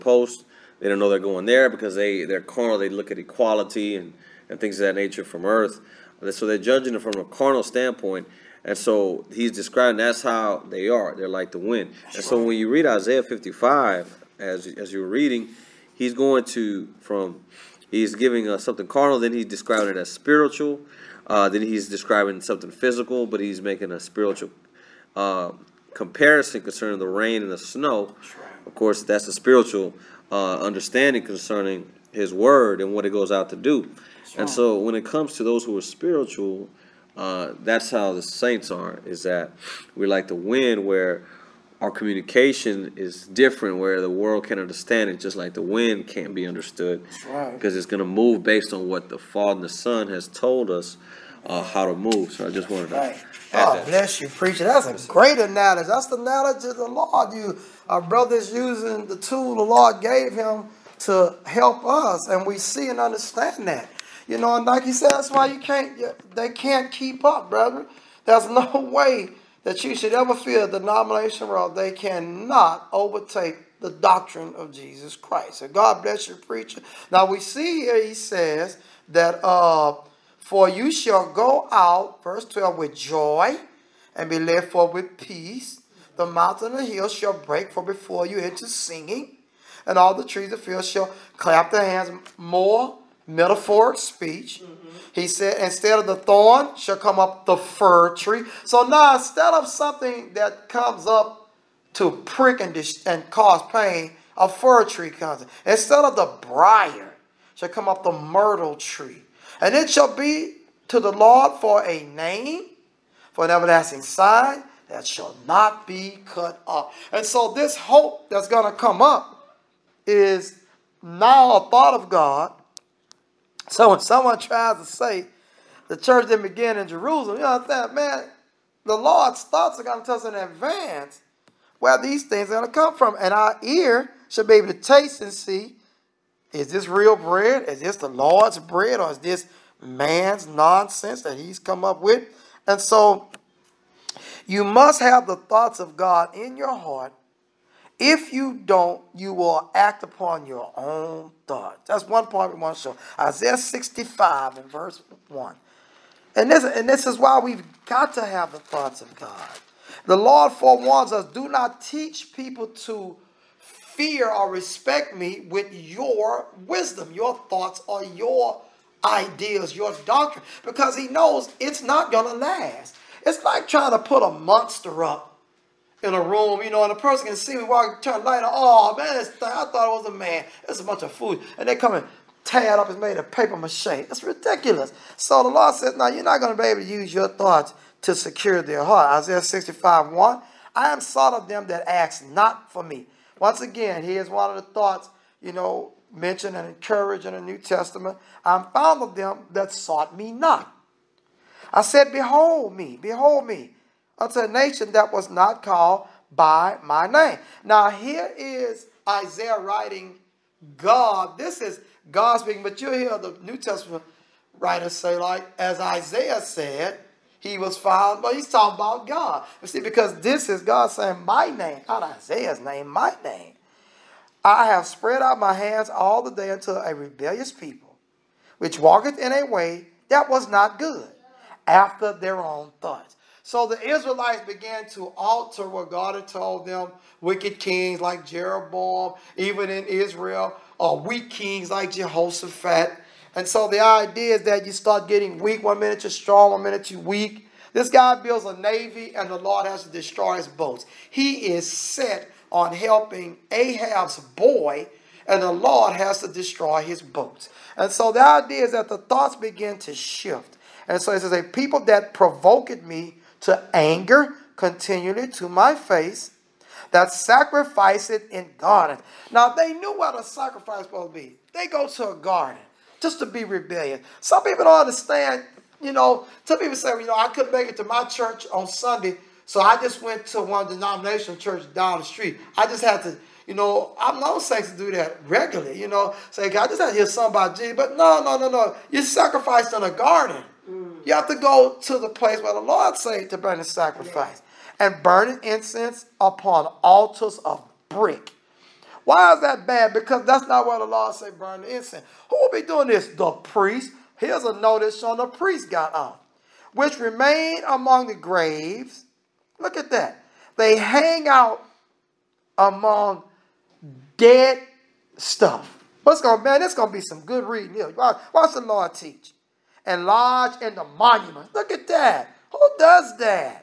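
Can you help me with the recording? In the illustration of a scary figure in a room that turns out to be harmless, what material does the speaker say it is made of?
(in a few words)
paper mache.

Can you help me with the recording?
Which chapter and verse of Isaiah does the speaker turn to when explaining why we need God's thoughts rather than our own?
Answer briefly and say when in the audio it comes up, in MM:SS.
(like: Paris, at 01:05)
Isaiah 65:1, at 02:33.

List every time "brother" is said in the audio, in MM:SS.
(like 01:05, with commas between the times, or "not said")
00:58, 01:07.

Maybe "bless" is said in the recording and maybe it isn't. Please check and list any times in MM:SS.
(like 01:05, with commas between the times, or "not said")
00:53, 01:16.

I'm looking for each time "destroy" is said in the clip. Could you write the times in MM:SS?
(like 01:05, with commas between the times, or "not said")
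04:09, 04:16.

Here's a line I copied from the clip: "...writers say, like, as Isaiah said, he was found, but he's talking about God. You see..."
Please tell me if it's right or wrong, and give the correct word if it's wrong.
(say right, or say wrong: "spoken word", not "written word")
right.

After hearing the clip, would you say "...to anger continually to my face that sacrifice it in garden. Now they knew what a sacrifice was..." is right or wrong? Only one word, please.
right.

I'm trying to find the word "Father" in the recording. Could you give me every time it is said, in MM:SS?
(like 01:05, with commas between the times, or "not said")
00:49.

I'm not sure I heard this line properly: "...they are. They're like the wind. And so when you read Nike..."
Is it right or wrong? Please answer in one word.
wrong.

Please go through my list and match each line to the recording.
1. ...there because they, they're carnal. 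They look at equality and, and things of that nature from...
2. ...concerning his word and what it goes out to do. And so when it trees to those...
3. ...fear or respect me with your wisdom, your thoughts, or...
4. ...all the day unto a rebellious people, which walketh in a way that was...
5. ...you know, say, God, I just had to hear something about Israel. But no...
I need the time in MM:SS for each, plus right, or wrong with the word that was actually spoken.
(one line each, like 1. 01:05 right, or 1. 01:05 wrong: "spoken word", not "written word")
1. 00:01 right
2. 00:31 wrong: "comes", not "trees"
3. 02:43 right
4. 03:45 right
5. 04:45 wrong: "Jesus", not "Israel".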